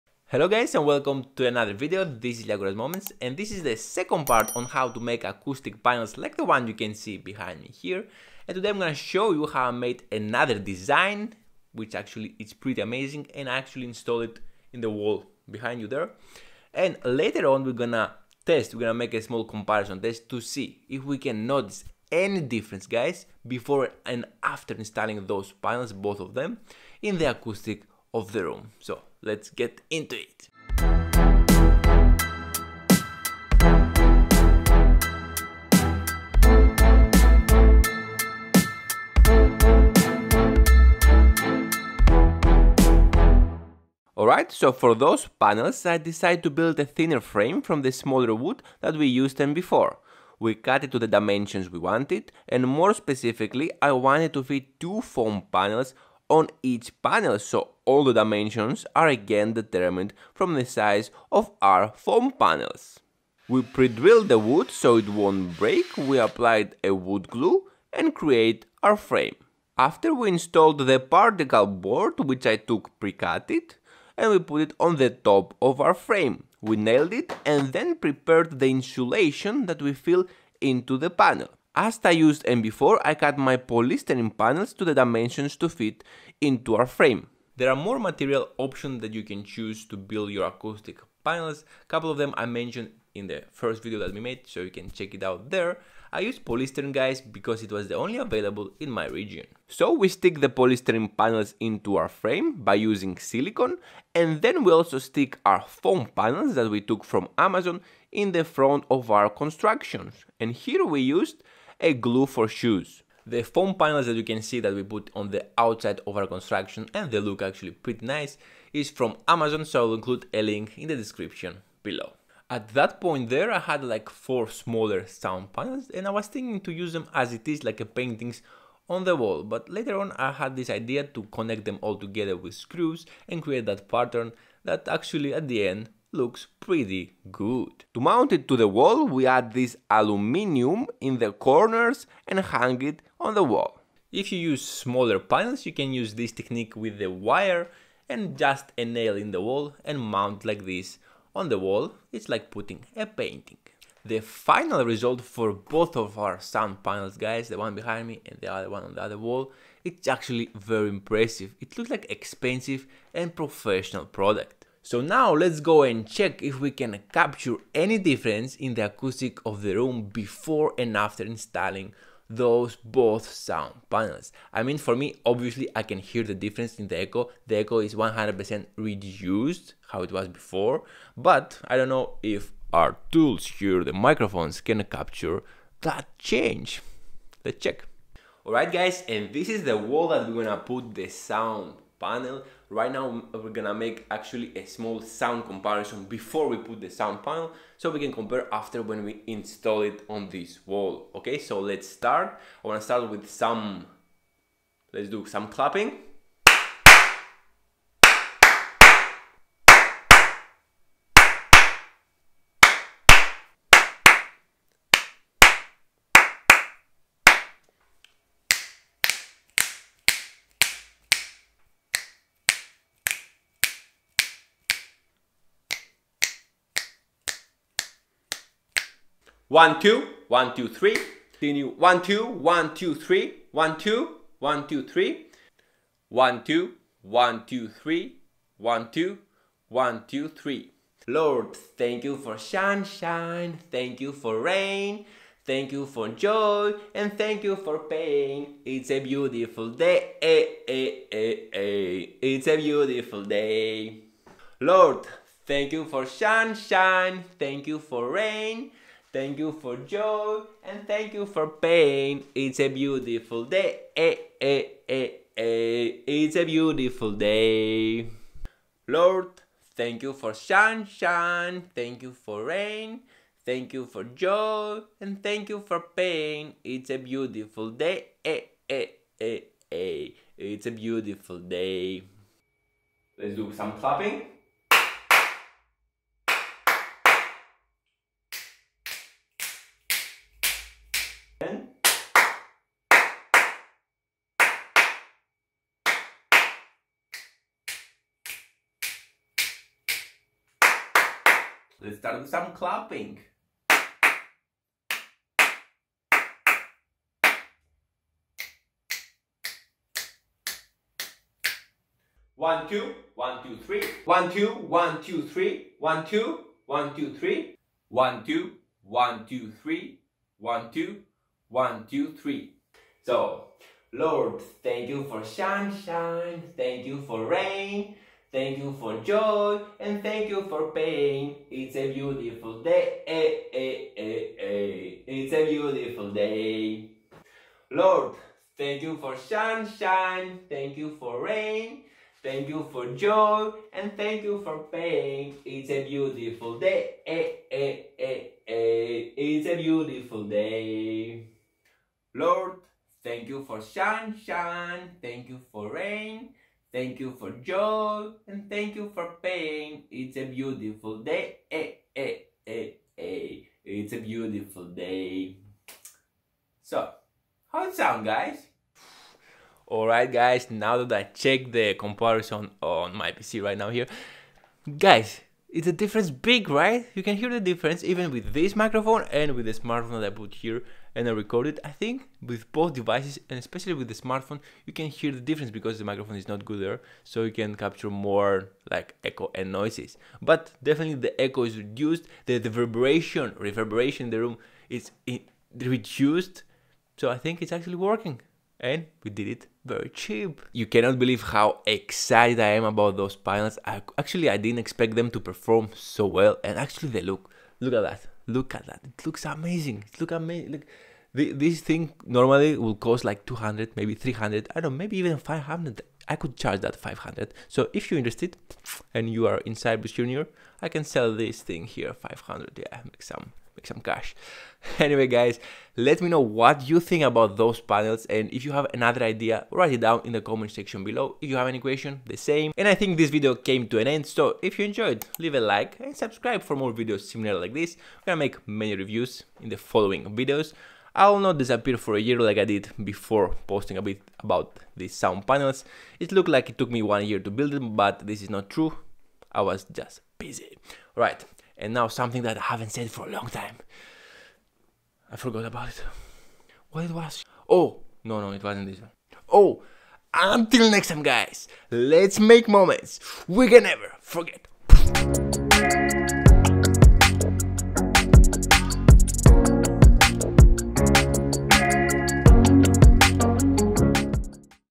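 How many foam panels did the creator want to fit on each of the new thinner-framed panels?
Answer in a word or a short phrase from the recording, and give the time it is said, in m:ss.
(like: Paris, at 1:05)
2, at 0:54.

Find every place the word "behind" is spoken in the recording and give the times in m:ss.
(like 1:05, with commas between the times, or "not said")
0:07, 0:15, 2:37.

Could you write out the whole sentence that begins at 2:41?
It looks like expensive and professional product.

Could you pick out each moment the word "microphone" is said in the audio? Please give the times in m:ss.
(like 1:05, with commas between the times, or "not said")
3:03, 6:18, 6:25.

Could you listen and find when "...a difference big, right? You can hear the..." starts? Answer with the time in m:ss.
6:15.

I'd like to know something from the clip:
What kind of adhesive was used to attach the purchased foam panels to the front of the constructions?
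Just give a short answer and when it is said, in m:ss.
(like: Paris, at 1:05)
Glue for shoes, at 1:51.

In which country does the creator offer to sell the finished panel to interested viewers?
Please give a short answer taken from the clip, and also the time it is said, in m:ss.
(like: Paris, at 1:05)
Cyprus, at 6:59.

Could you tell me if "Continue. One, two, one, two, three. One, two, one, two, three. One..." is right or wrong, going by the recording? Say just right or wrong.
right.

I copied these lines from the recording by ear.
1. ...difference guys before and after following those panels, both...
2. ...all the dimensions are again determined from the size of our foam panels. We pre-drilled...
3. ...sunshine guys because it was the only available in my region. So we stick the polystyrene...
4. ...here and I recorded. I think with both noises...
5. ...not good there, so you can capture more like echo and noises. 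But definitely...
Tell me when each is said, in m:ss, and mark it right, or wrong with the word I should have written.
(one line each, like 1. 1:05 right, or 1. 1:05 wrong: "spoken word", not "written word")
1. 0:22 wrong: "installing", not "following"
2. 0:57 right
3. 1:36 wrong: "polystyrene", not "sunshine"
4. 6:20 wrong: "devices", not "noises"
5. 6:26 right.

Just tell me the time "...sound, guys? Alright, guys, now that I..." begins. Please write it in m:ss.
6:07.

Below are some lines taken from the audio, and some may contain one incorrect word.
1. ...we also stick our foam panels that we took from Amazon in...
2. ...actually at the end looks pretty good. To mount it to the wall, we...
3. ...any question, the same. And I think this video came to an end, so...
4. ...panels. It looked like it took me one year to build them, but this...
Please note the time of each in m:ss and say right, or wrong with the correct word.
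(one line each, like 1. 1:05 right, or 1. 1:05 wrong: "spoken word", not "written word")
1. 1:44 right
2. 2:14 right
3. 7:11 right
4. 7:25 right.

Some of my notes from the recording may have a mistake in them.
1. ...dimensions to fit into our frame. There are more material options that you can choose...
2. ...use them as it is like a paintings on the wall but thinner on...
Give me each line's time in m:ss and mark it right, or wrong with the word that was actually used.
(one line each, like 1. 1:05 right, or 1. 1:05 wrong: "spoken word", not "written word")
1. 1:24 right
2. 2:06 wrong: "later", not "thinner".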